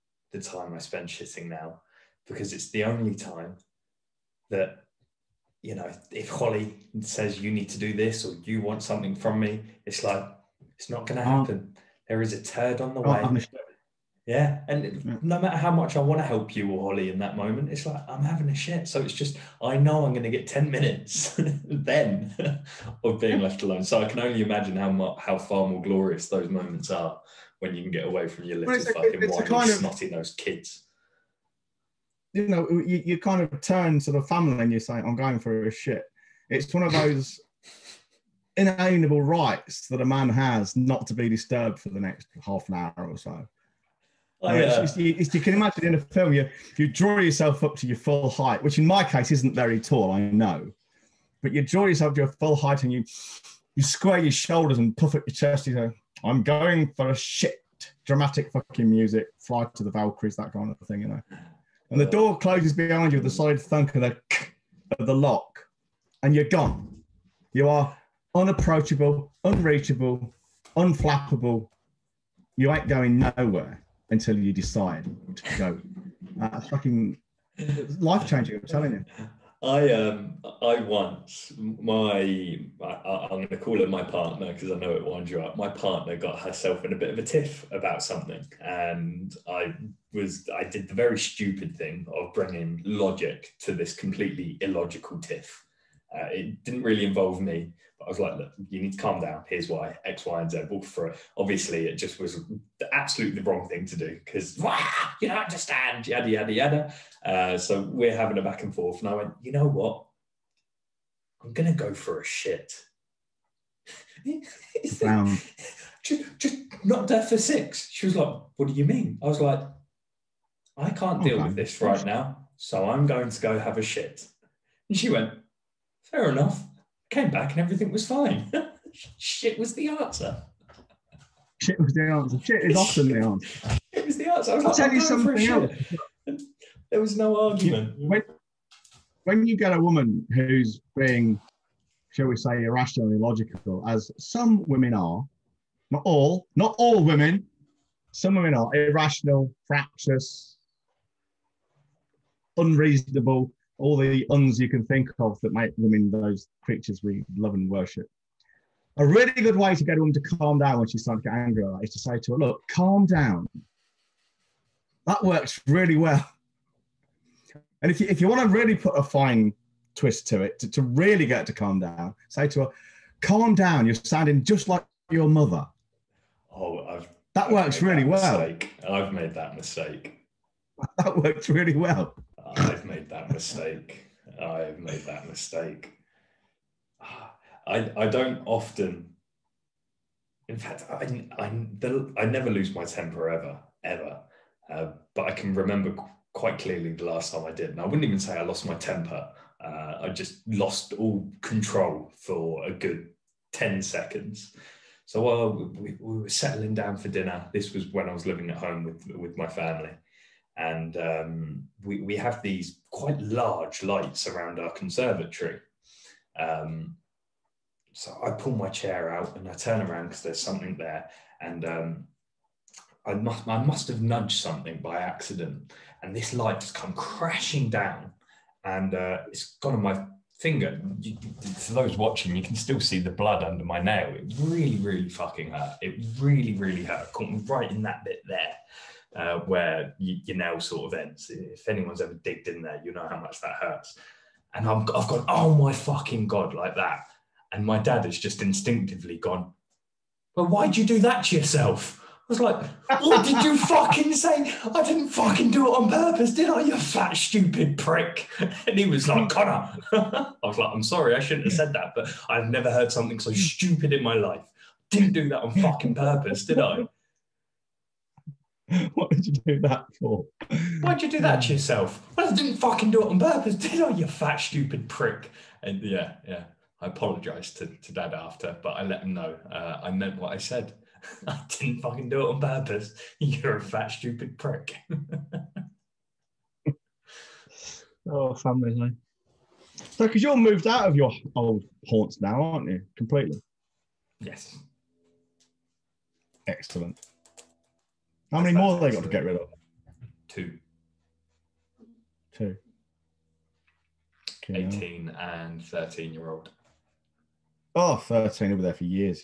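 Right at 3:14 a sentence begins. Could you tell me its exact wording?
Uh, but I can remember quite clearly the last time I did.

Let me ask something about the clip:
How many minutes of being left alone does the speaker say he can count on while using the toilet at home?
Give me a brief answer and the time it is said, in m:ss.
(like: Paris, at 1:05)
10, at 0:20.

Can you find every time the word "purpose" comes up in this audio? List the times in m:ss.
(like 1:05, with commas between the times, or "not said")
4:15, 4:25, 4:33, 4:42.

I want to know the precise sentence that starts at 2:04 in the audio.
And she went, fair enough came back and everything was fine.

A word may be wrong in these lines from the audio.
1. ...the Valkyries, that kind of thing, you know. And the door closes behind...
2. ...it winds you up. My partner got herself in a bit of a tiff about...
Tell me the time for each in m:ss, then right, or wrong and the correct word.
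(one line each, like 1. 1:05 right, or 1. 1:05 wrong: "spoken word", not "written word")
1. 0:59 right
2. 1:24 right.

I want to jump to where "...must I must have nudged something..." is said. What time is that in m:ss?
3:43.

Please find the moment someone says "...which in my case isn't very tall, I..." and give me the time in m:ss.
0:48.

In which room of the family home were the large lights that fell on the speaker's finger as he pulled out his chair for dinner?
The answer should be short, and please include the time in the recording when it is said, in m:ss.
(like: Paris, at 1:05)
Conservatory, at 3:34.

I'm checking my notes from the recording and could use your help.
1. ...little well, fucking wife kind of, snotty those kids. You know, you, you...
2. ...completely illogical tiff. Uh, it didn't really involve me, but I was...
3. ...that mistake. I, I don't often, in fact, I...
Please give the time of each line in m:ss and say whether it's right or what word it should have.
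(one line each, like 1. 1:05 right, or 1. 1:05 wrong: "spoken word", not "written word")
1. 0:28 right
2. 1:33 right
3. 3:05 right.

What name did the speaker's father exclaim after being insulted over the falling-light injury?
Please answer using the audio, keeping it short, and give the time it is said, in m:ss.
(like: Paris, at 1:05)
Connor, at 4:19.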